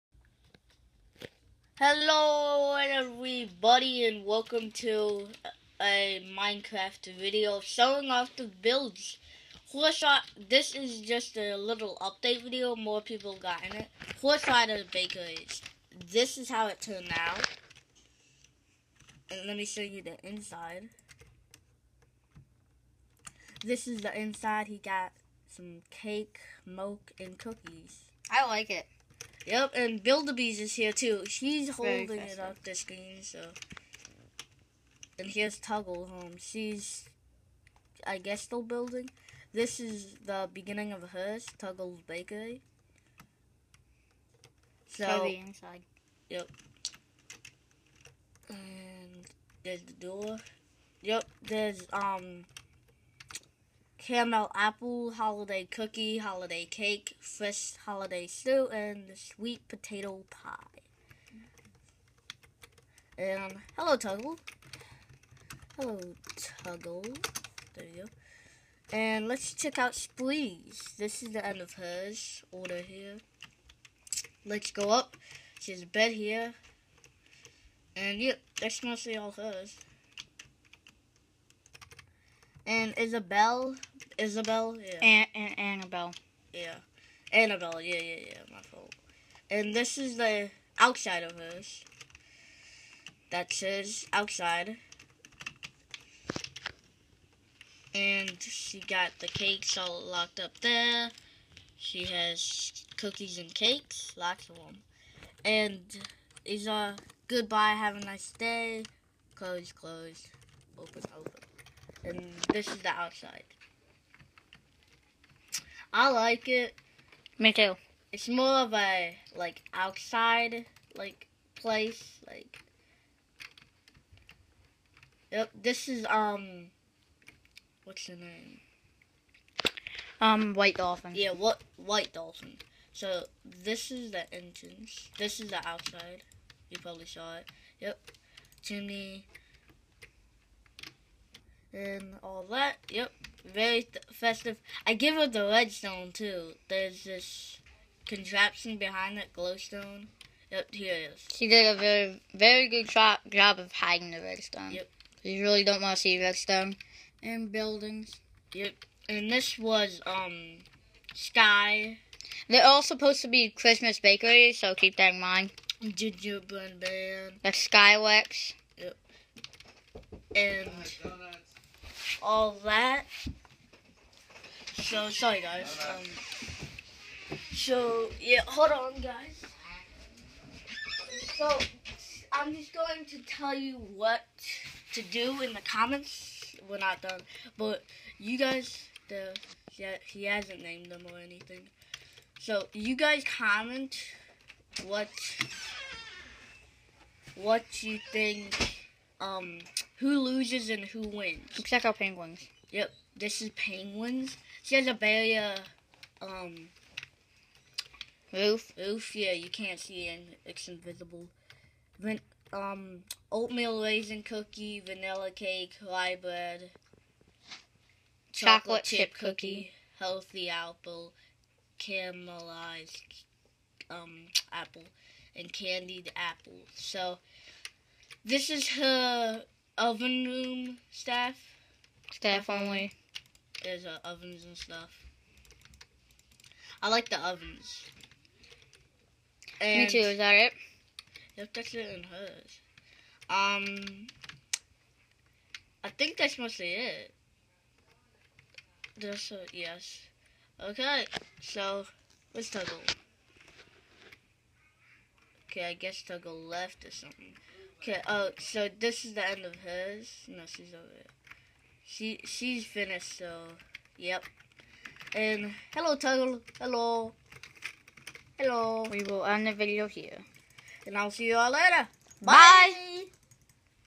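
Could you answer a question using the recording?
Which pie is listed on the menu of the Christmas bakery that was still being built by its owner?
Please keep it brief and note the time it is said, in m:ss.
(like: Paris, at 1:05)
sweet potato pie, at 0:59.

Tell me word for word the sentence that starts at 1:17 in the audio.
And yep, that's mostly all hers and Isabel, Isabel, yeah.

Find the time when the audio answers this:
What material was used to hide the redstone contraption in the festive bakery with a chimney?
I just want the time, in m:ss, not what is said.
2:29.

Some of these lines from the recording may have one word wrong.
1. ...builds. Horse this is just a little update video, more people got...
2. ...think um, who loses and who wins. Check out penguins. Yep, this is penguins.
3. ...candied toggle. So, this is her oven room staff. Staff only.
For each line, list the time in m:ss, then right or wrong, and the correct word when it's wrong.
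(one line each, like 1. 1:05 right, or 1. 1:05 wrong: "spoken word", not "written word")
1. 0:08 right
2. 3:18 right
3. 3:45 wrong: "apple", not "toggle".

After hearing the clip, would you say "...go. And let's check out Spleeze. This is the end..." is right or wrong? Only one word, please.
right.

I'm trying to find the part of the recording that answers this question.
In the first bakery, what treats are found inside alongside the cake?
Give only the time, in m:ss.
0:26.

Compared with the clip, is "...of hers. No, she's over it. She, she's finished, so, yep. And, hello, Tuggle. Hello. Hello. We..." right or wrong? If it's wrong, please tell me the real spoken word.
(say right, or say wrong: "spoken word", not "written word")
right.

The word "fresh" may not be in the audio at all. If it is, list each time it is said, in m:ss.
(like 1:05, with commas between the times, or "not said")
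0:57.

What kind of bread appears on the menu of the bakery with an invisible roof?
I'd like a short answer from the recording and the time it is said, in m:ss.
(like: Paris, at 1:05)
rye bread, at 3:35.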